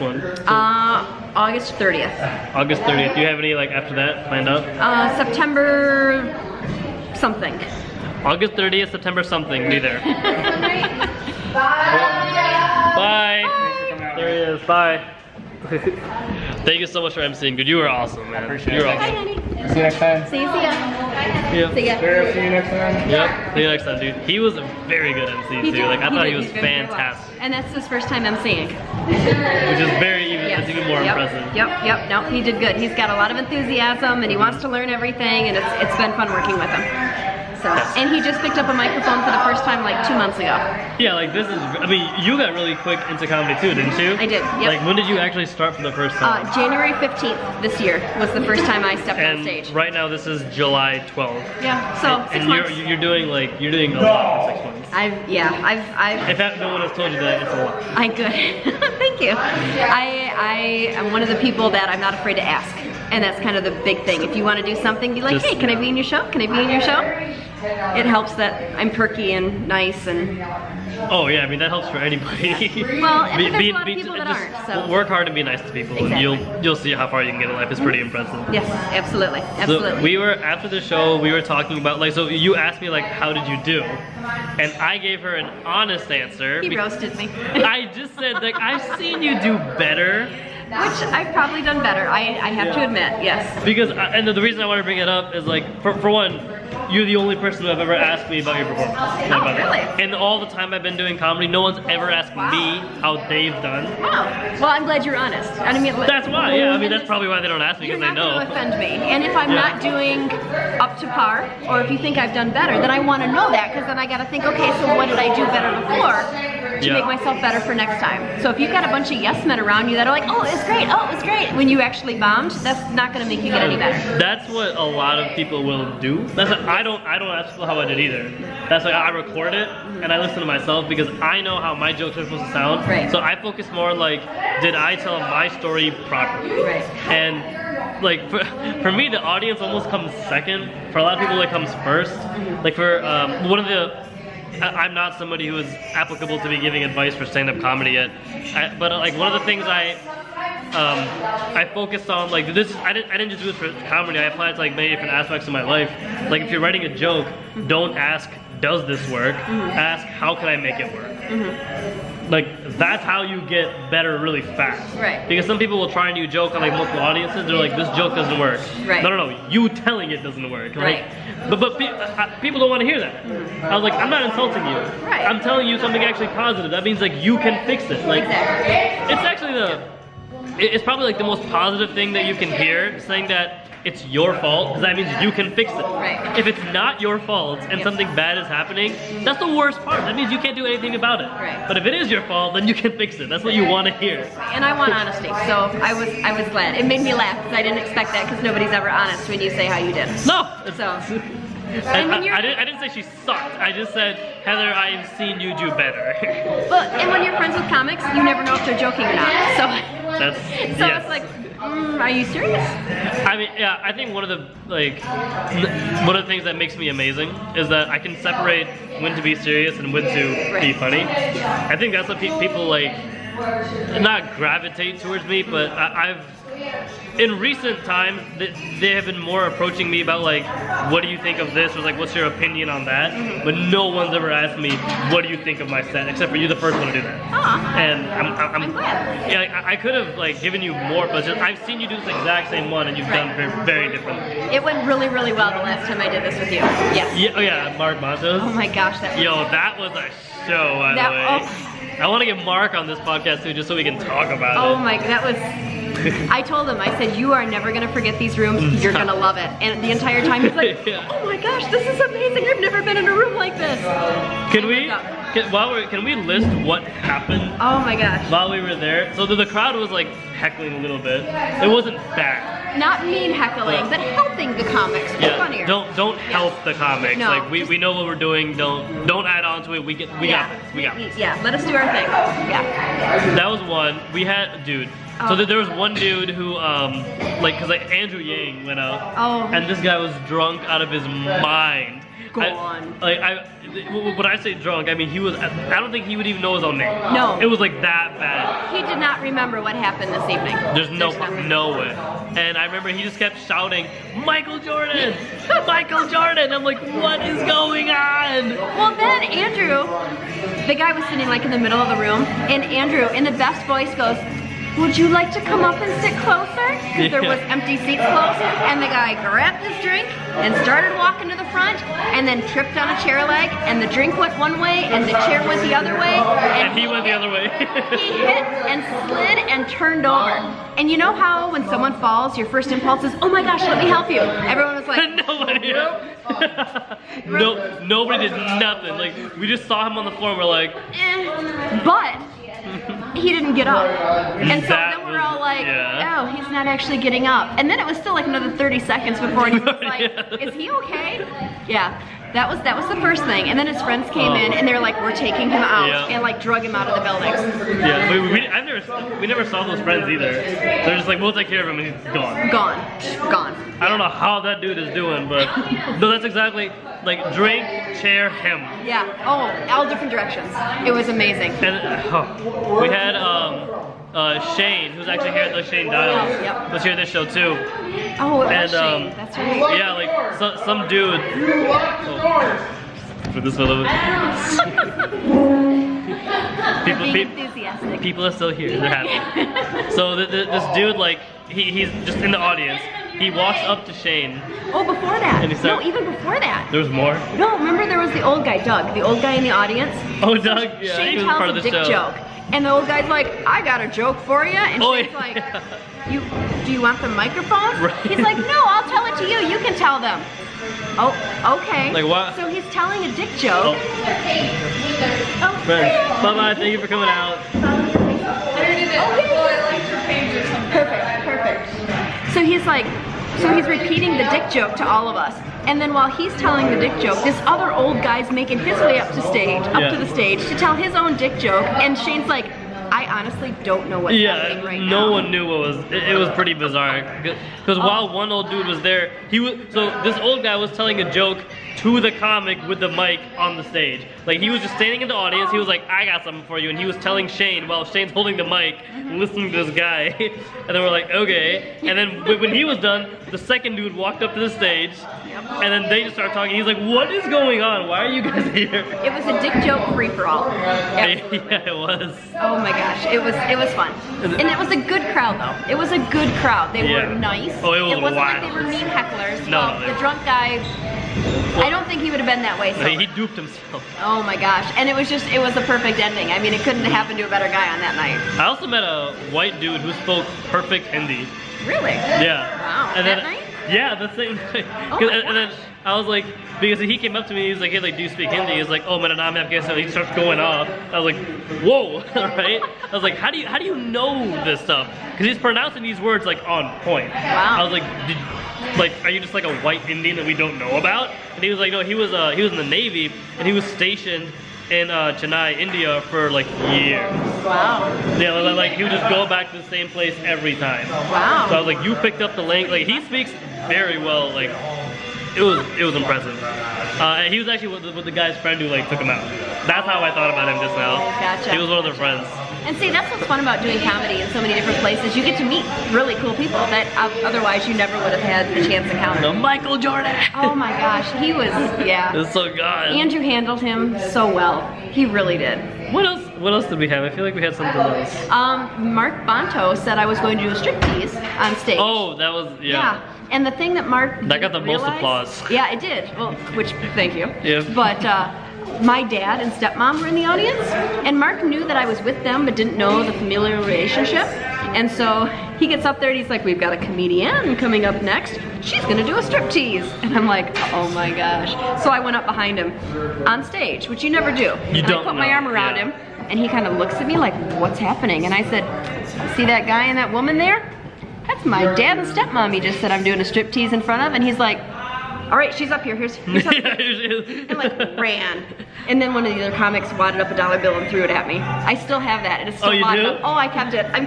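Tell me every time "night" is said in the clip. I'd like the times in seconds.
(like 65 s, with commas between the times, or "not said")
477 s, 483 s.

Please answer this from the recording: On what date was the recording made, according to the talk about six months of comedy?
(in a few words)
July 12th.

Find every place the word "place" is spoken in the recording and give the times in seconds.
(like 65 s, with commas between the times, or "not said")
509 s, 524 s.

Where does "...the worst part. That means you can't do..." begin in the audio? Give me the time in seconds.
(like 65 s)
189 s.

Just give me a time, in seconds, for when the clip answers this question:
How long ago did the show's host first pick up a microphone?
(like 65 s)
39 s.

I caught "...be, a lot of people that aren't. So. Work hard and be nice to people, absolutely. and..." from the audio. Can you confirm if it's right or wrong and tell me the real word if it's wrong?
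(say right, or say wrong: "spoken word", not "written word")
wrong: "exactly", not "absolutely".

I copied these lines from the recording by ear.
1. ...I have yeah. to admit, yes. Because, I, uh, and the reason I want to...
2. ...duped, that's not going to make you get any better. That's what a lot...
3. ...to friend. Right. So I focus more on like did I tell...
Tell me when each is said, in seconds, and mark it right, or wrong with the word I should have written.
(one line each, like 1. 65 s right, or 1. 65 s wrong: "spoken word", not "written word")
1. 92 s right
2. 122 s wrong: "bombed", not "duped"
3. 132 s wrong: "sound", not "friend".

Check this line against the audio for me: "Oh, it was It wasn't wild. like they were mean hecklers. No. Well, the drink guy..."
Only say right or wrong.
wrong.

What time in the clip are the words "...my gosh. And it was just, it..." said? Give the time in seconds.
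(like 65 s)
474 s.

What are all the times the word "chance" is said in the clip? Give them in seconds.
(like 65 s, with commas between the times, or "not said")
528 s.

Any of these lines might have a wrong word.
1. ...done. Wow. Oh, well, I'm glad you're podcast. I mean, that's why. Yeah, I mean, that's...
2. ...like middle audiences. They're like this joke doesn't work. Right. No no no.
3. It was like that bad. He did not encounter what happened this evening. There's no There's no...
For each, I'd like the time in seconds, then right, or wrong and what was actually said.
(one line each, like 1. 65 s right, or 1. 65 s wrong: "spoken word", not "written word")
1. 103 s wrong: "honest", not "podcast"
2. 166 s wrong: "multiple", not "middle"
3. 297 s wrong: "remember", not "encounter".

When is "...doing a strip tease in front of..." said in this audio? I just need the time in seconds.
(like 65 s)
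573 s.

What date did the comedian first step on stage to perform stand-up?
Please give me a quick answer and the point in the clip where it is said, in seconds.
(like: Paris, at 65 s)
January 15th, at 46 s.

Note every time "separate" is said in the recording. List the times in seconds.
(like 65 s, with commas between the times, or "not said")
218 s.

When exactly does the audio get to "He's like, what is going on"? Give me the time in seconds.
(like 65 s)
456 s.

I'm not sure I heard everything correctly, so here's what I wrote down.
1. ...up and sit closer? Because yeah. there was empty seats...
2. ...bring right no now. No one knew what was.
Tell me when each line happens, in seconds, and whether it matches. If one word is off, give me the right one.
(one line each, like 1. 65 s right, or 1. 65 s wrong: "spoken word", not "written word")
1. 315 s right
2. 434 s wrong: "happening", not "bring".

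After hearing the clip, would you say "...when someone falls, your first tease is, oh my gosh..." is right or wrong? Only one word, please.
wrong.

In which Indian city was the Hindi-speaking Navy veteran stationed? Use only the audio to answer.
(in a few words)
Chennai.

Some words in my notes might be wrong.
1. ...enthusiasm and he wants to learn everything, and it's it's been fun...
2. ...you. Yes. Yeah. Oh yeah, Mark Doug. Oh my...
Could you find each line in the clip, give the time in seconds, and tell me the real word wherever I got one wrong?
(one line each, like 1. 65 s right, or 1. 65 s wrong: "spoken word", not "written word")
1. 33 s right
2. 246 s wrong: "Matos", not "Doug".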